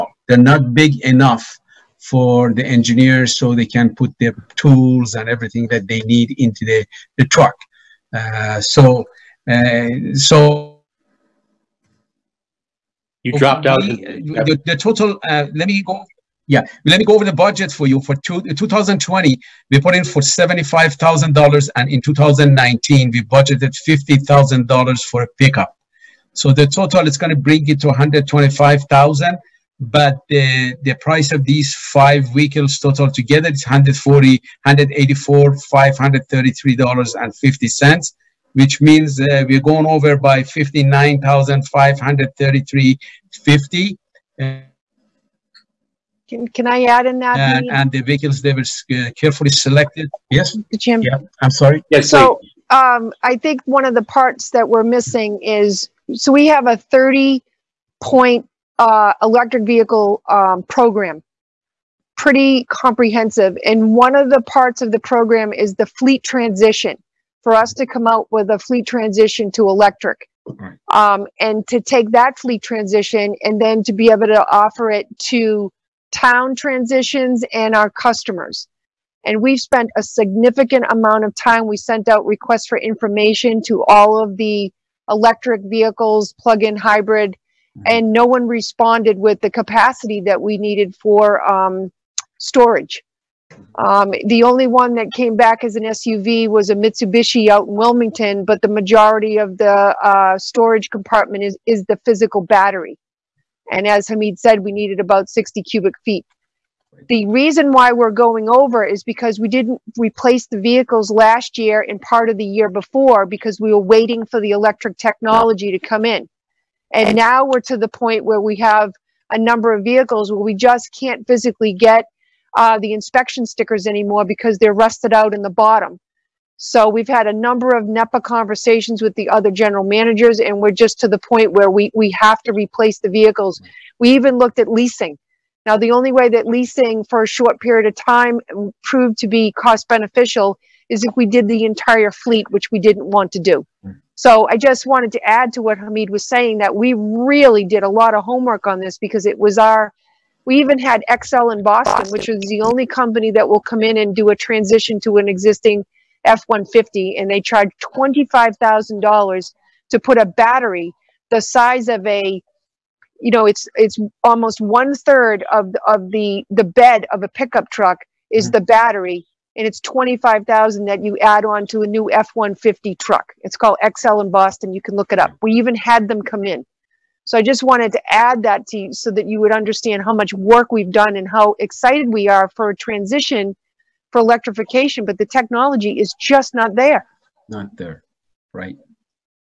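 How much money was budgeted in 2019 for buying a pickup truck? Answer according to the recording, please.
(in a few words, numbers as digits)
$50,000.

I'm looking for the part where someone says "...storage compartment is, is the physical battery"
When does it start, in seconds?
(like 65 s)
100 s.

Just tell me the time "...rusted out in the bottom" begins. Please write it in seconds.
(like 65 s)
124 s.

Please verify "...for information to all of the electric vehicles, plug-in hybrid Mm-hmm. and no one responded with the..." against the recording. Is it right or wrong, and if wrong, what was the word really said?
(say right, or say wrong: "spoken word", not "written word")
right.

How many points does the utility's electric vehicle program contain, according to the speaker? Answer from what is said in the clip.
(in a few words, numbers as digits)
30.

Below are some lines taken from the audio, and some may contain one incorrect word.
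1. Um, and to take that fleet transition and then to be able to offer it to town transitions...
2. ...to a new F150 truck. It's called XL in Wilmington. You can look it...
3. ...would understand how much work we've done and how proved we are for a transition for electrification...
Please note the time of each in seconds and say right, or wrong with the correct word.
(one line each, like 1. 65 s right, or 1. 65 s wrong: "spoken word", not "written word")
1. 70 s right
2. 171 s wrong: "Boston", not "Wilmington"
3. 179 s wrong: "excited", not "proved".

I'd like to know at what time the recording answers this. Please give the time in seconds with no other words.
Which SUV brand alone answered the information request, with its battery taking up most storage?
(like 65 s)
96 s.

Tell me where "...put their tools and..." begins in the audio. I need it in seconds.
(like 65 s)
3 s.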